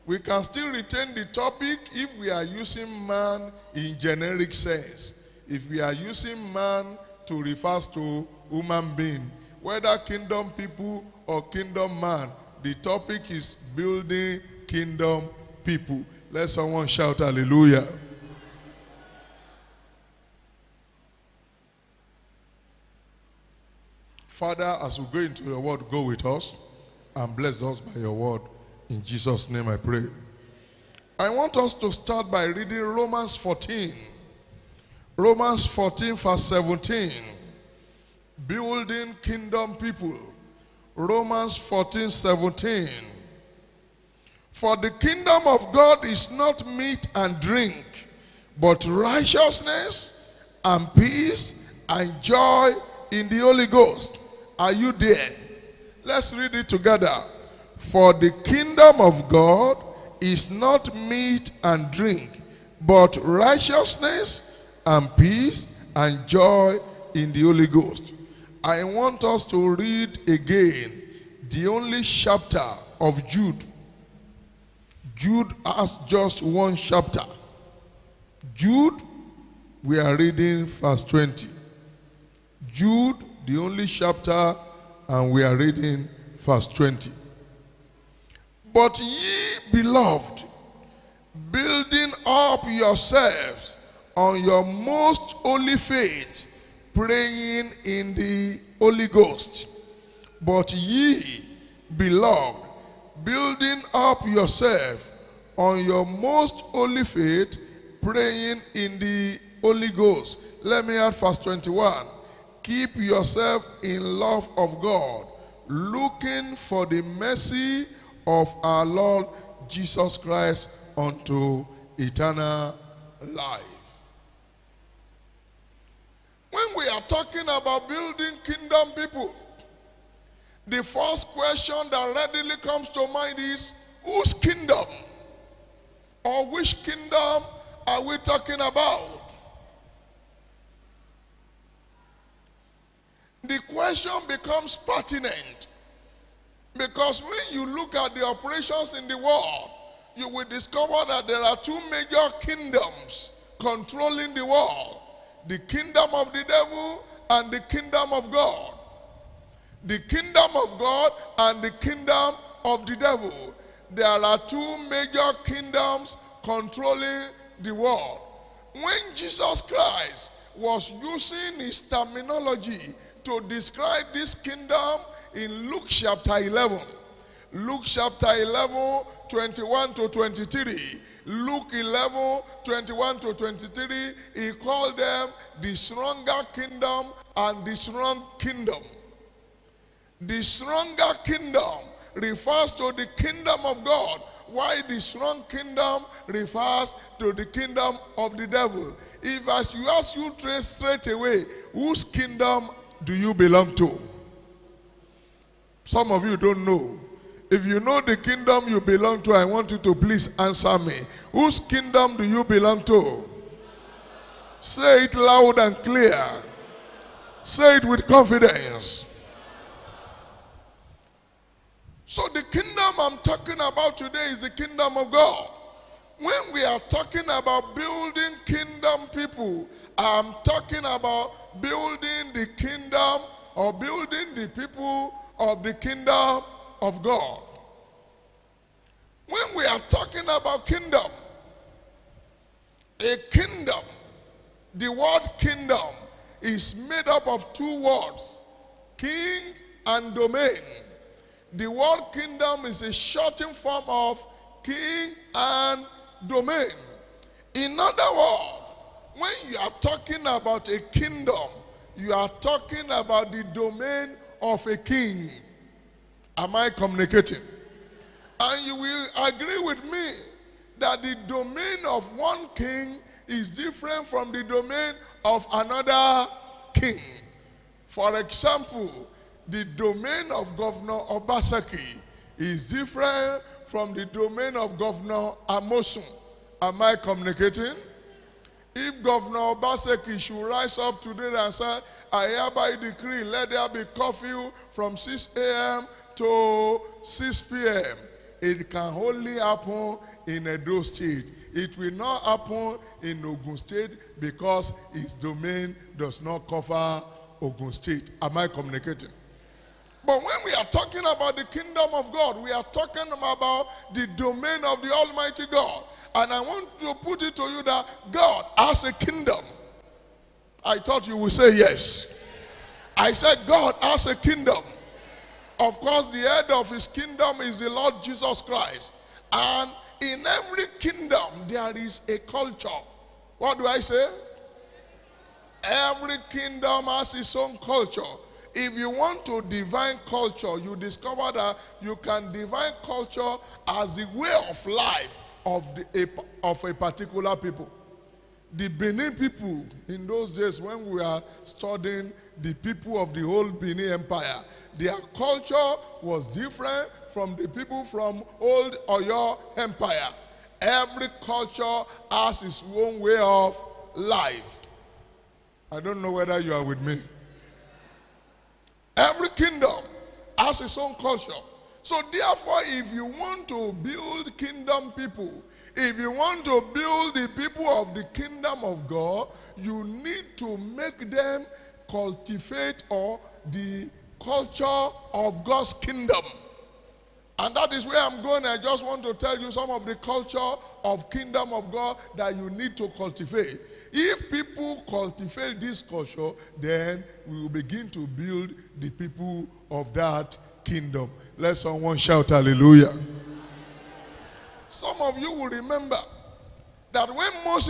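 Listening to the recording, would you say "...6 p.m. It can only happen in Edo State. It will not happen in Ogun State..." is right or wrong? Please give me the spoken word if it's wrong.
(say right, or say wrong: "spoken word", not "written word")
right.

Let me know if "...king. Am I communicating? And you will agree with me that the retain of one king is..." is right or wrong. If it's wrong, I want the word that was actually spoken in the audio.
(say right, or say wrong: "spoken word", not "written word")
wrong: "domain", not "retain".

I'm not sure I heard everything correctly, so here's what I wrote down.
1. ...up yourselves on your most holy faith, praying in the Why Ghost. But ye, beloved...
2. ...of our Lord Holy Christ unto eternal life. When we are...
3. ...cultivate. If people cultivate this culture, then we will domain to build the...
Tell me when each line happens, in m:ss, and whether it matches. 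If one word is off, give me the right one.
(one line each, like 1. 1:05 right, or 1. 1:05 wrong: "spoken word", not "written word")
1. 1:32 wrong: "Holy", not "Why"
2. 1:58 wrong: "Jesus", not "Holy"
3. 6:32 wrong: "begin", not "domain".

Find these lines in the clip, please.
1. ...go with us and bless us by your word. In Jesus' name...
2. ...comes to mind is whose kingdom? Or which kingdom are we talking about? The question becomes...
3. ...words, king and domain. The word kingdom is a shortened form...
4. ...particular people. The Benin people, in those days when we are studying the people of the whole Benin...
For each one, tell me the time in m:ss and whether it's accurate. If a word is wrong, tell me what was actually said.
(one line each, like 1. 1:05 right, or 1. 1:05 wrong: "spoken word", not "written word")
1. 0:25 right
2. 2:12 right
3. 4:07 right
4. 5:46 right.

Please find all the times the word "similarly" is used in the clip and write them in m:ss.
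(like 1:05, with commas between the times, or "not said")
not said.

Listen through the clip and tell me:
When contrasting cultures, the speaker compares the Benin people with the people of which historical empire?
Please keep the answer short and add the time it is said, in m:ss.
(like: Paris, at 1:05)
Old Oyo Empire, at 5:58.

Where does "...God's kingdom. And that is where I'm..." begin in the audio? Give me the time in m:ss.
6:25.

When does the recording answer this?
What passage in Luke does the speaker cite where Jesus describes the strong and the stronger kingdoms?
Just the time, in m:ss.
2:57.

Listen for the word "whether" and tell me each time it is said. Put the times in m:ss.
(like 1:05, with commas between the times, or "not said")
0:09, 6:06.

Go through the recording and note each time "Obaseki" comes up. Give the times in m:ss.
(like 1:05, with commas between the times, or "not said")
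4:41, 4:49.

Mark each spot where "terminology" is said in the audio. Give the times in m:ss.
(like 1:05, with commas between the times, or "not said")
2:51.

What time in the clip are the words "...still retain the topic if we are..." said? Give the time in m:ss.
0:00.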